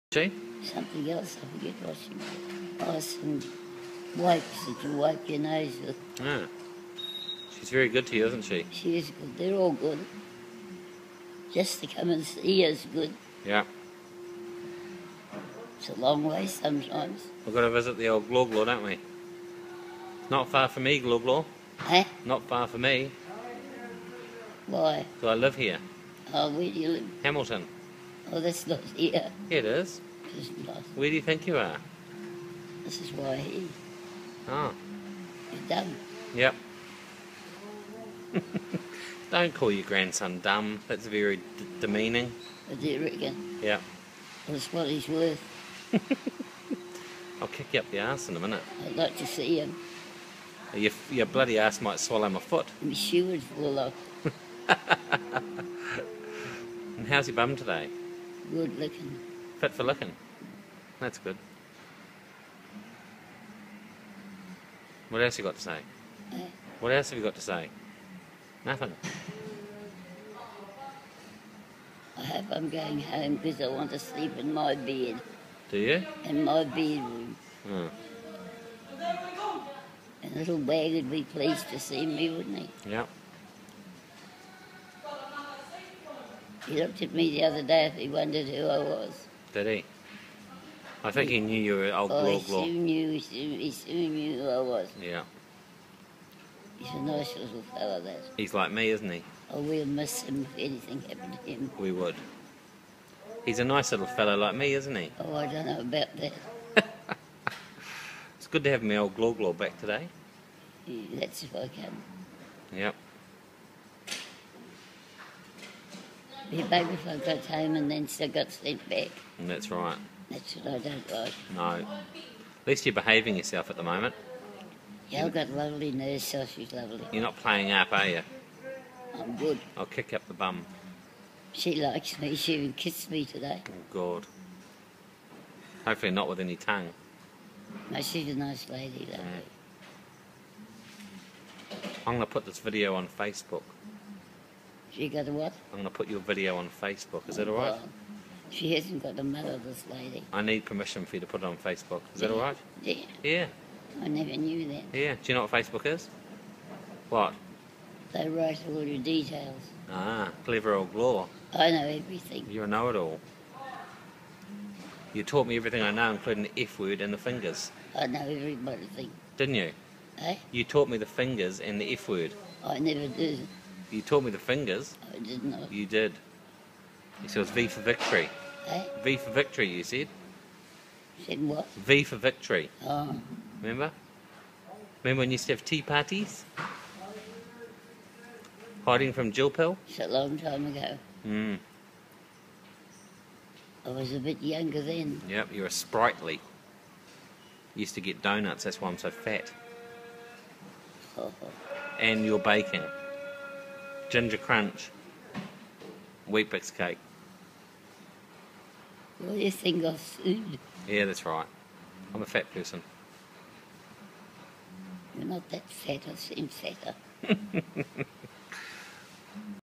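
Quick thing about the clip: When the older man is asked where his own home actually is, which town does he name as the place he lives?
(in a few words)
Hamilton.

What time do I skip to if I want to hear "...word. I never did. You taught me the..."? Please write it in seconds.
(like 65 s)
172 s.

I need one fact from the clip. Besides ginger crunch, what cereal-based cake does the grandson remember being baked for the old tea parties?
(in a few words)
Weet-Bix cake.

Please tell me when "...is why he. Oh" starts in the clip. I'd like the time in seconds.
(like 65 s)
33 s.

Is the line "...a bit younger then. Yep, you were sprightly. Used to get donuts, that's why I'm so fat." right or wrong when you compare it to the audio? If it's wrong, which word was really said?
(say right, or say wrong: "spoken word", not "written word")
right.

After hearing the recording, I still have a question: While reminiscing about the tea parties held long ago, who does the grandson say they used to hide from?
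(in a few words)
Jill Pill.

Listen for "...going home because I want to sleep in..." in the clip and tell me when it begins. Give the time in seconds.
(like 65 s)
72 s.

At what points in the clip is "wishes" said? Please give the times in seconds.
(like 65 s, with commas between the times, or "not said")
not said.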